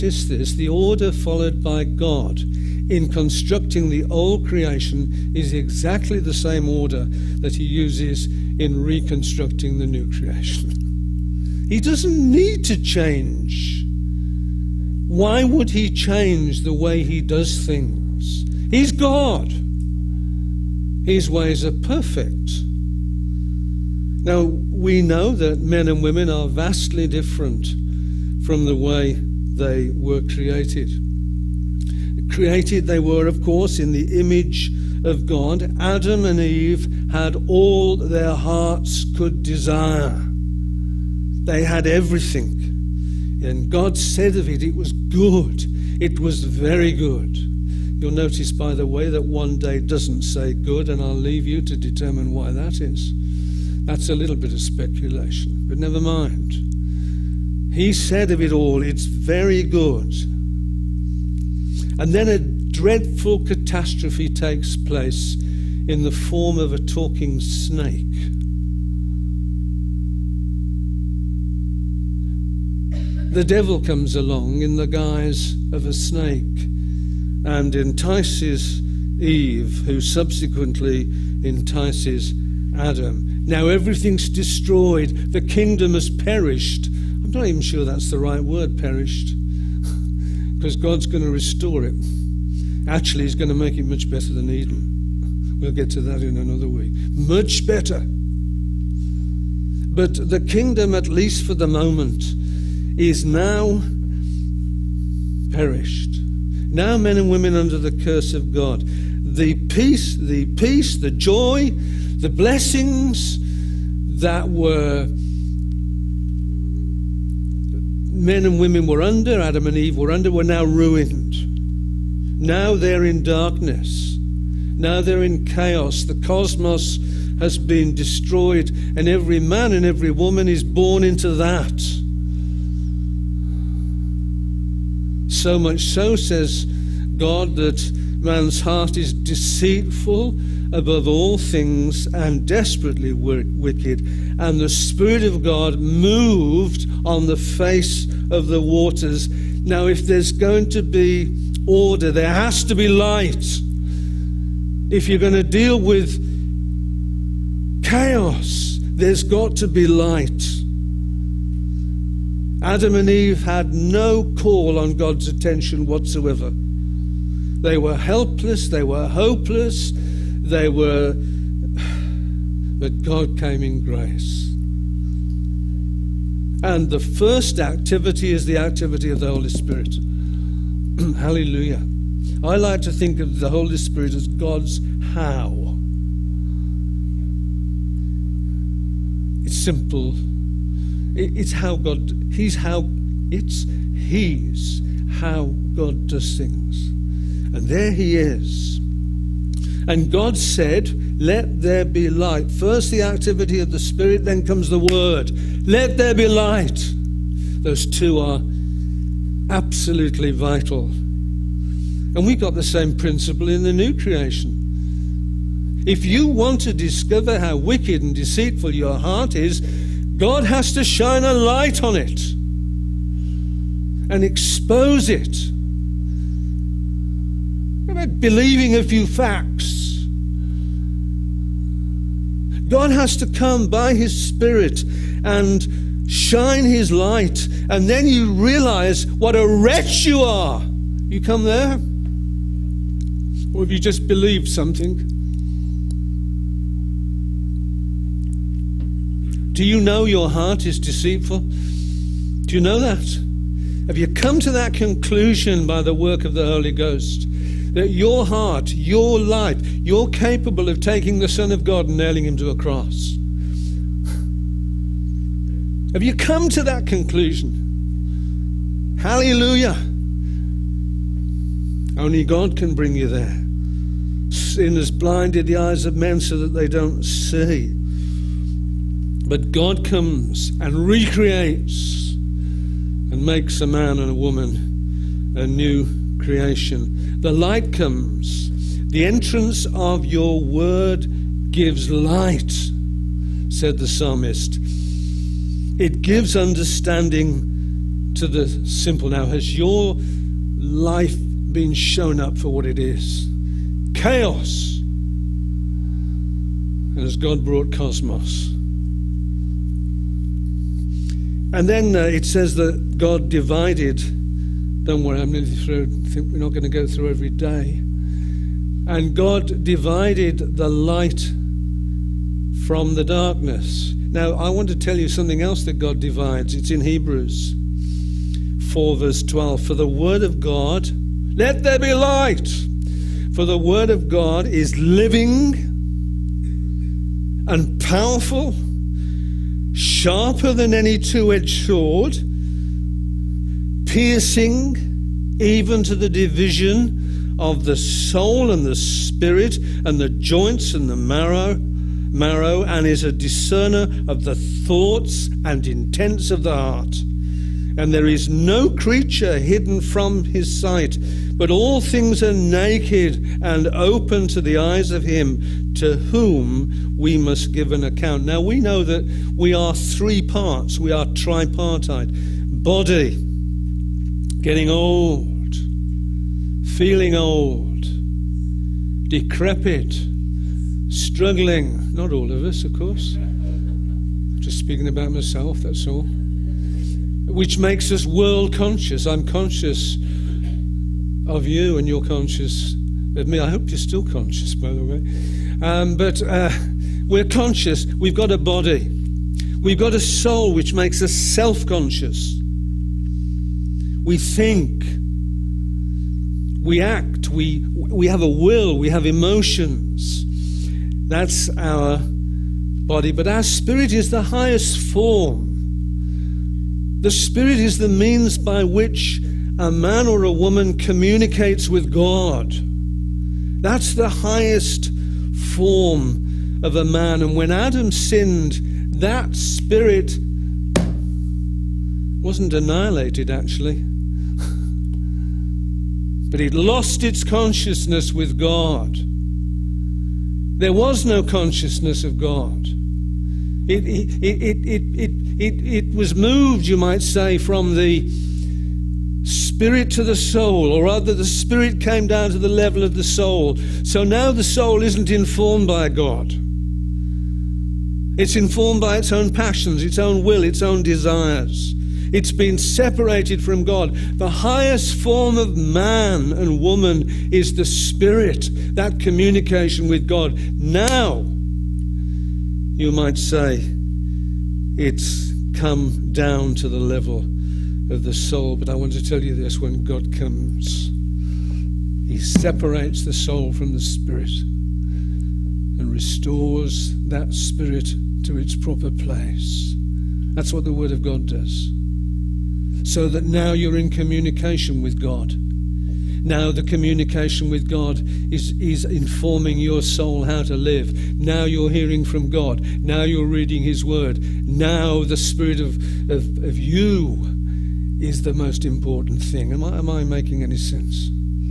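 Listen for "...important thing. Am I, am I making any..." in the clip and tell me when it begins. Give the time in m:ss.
8:28.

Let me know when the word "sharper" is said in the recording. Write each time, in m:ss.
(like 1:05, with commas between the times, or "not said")
5:39.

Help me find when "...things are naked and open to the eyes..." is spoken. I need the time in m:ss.
6:01.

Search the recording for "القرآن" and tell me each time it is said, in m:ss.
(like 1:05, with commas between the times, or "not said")
not said.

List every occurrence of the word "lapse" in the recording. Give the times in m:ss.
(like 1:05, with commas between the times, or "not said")
not said.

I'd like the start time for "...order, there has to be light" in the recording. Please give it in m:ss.
2:31.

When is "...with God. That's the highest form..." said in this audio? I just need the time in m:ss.
7:01.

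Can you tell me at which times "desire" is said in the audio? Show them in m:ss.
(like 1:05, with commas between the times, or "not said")
0:39, 7:40.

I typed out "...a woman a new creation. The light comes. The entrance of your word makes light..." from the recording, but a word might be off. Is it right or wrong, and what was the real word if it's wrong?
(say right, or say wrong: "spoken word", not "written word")
wrong: "gives", not "makes".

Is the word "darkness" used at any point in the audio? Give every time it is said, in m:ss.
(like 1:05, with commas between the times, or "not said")
2:03, 5:23.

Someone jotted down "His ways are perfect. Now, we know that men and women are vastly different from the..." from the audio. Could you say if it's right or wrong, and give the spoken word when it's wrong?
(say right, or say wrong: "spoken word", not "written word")
right.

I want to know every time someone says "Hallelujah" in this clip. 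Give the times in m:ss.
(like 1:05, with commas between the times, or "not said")
3:00, 4:28.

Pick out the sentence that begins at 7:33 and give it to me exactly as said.
So now the soul isn't informed by God.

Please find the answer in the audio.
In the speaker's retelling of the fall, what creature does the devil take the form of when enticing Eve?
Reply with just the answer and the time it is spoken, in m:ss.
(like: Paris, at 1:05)
A talking snake, at 1:06.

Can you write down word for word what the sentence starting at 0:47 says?
You'll notice, by the way, that one day doesn't say good, and I'll leave you to determine why that is.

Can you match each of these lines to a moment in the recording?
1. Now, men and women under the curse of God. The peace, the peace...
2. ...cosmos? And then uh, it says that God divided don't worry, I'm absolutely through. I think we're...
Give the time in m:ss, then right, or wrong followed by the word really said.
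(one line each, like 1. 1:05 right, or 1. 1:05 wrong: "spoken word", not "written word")
1. 1:46 right
2. 5:07 wrong: "nearly", not "absolutely".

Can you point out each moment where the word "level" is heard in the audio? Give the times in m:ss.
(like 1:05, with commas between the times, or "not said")
7:32, 7:56.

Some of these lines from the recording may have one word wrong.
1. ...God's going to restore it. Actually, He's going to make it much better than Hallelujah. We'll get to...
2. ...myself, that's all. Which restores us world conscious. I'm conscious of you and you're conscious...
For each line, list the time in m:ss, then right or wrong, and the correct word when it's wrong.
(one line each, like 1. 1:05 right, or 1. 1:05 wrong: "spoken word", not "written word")
1. 1:30 wrong: "Eden", not "Hallelujah"
2. 6:25 wrong: "makes", not "restores".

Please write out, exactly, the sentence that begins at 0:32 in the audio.
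Created they were, of course, in the image of God.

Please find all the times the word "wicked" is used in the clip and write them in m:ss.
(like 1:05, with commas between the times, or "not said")
2:23, 3:37.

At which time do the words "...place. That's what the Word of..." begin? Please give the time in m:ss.
8:08.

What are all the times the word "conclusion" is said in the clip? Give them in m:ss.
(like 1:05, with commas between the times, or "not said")
4:14, 4:26.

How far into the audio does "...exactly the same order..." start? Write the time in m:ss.
0:05.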